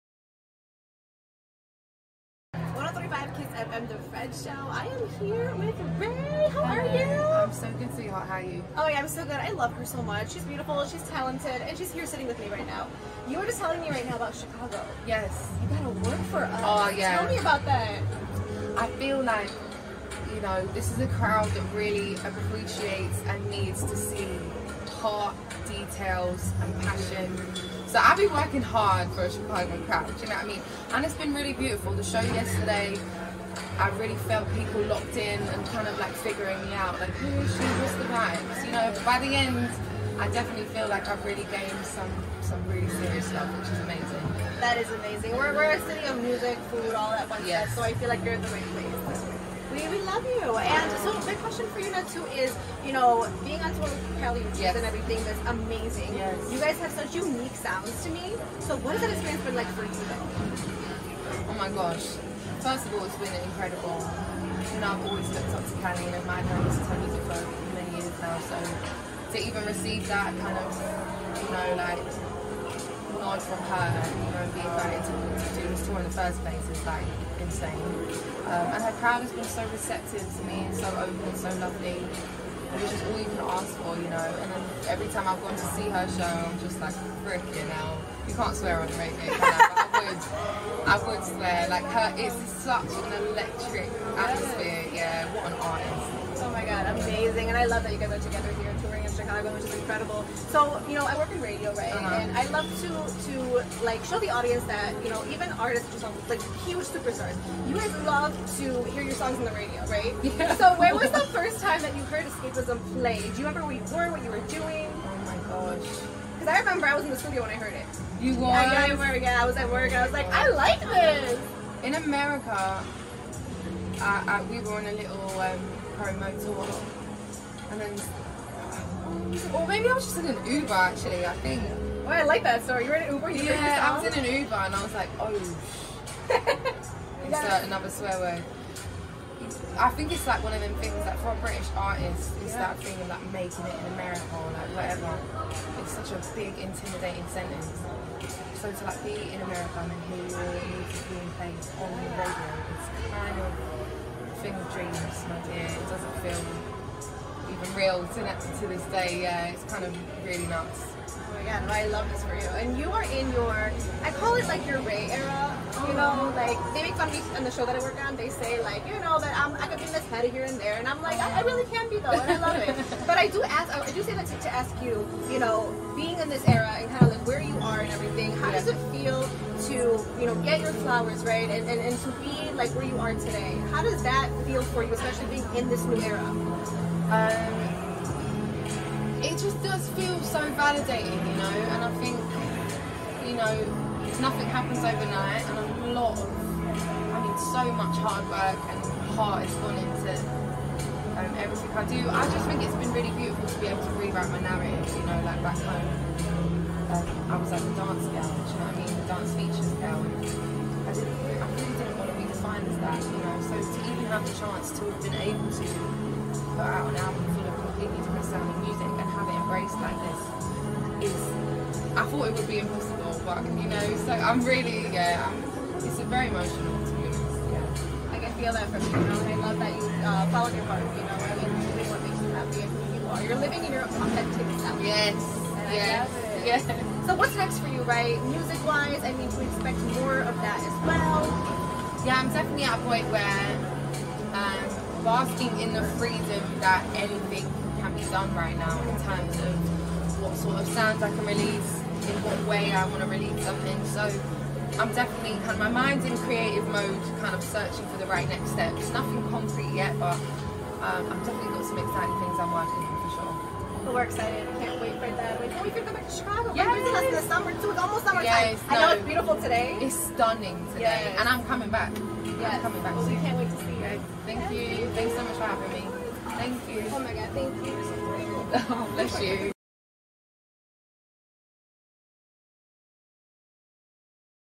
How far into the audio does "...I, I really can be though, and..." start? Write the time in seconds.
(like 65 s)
171 s.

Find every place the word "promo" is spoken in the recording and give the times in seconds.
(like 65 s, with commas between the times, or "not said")
125 s.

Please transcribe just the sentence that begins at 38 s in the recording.
But by the end, I definitely feel like I've really gained some some really serious love, which is amazing.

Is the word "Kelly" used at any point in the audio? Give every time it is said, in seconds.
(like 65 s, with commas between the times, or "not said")
54 s, 65 s.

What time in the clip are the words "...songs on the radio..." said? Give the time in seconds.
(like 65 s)
109 s.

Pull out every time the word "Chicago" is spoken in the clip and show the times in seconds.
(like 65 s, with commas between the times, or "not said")
14 s, 29 s, 99 s, 266 s.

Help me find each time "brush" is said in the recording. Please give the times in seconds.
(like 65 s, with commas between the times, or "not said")
not said.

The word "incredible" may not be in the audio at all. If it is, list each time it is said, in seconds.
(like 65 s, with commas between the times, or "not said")
63 s, 99 s.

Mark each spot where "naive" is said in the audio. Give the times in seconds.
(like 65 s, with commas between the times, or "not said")
not said.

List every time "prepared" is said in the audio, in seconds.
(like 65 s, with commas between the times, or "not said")
not said.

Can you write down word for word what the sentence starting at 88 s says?
You can't swear on the radio would, I would swear.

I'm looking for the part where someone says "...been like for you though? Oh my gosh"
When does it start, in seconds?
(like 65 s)
59 s.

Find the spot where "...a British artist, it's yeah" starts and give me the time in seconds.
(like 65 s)
141 s.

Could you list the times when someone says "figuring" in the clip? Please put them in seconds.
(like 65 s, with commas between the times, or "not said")
36 s.